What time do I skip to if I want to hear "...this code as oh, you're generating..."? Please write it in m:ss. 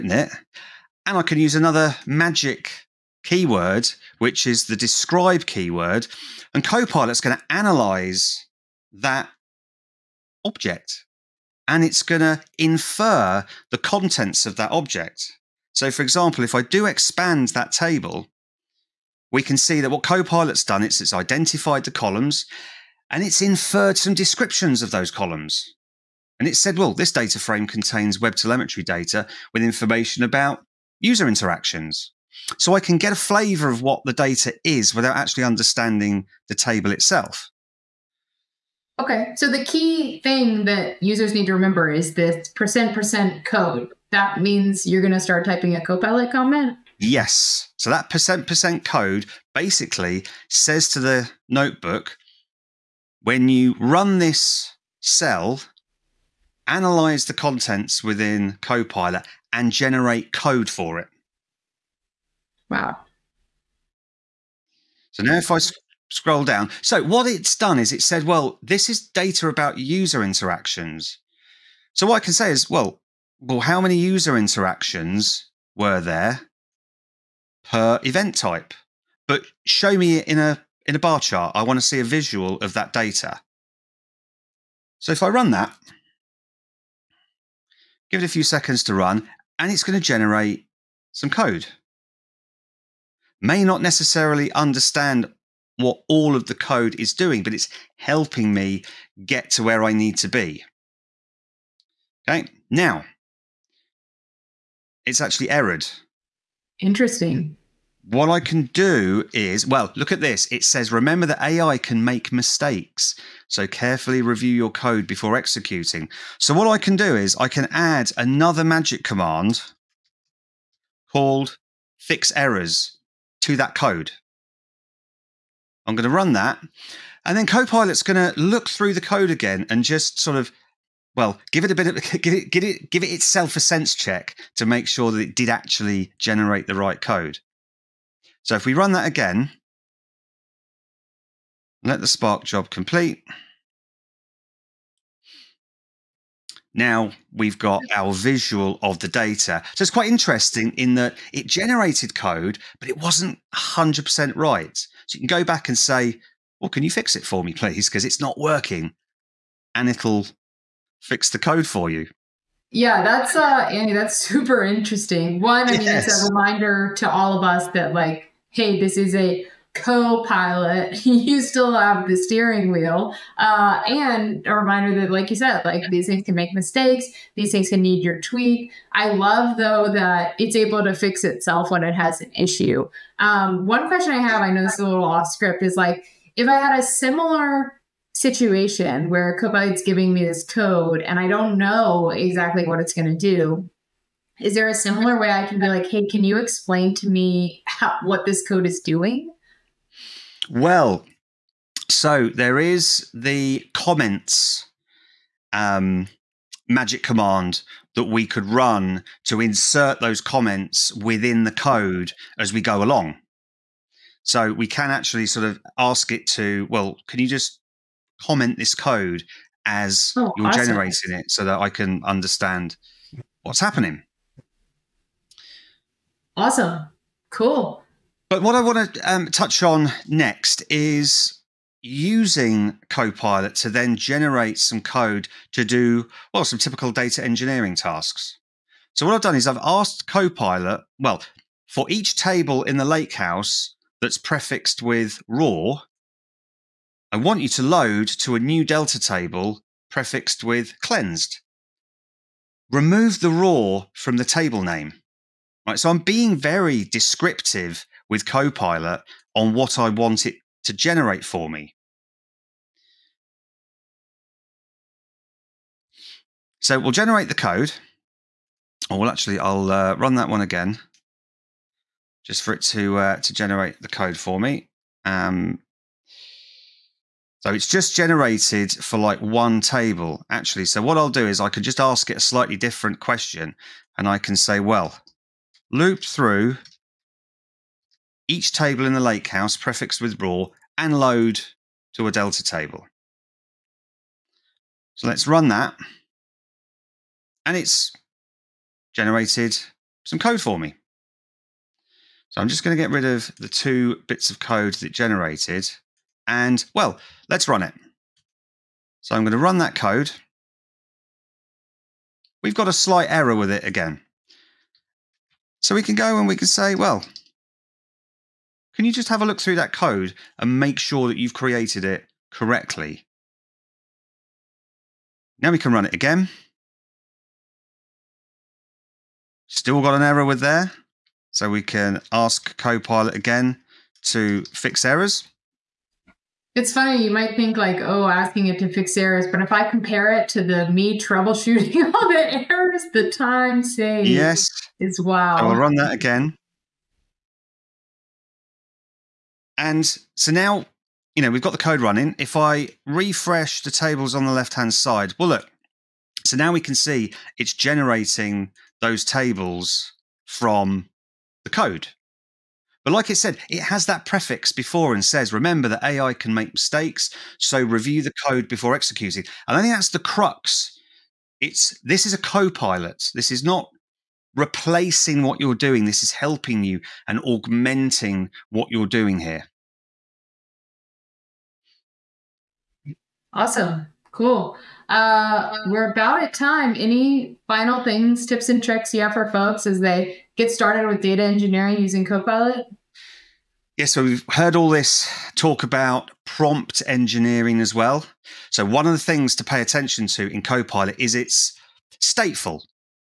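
3:38.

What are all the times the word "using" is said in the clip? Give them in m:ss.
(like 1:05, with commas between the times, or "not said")
3:51, 6:31.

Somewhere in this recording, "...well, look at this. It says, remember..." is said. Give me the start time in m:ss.
1:49.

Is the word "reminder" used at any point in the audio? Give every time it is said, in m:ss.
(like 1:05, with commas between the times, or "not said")
2:46, 2:54.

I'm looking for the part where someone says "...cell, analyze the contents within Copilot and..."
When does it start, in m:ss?
0:54.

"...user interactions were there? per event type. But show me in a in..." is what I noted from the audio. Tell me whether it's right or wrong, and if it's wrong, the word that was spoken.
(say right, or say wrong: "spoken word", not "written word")
right.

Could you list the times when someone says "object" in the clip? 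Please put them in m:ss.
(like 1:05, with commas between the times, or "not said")
0:10, 0:14.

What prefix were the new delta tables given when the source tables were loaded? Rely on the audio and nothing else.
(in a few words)
cleansed.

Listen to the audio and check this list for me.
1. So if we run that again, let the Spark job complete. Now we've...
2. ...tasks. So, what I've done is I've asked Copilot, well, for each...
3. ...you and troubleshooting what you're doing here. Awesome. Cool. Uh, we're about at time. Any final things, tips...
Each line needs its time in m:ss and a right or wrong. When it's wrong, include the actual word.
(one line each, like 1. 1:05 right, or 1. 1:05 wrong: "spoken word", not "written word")
1. 2:18 right
2. 3:57 right
3. 6:16 wrong: "augmenting", not "troubleshooting".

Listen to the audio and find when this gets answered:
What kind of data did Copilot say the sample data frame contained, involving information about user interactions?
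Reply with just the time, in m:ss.
0:28.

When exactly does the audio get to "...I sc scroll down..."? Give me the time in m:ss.
1:05.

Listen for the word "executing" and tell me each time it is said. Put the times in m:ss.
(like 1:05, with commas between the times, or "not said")
1:55, 6:08.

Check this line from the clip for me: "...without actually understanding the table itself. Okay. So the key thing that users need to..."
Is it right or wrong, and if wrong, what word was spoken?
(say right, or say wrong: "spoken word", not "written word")
right.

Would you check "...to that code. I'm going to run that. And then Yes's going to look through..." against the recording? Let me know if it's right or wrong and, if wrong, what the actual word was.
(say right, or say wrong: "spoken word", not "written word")
wrong: "Copilot", not "Yes".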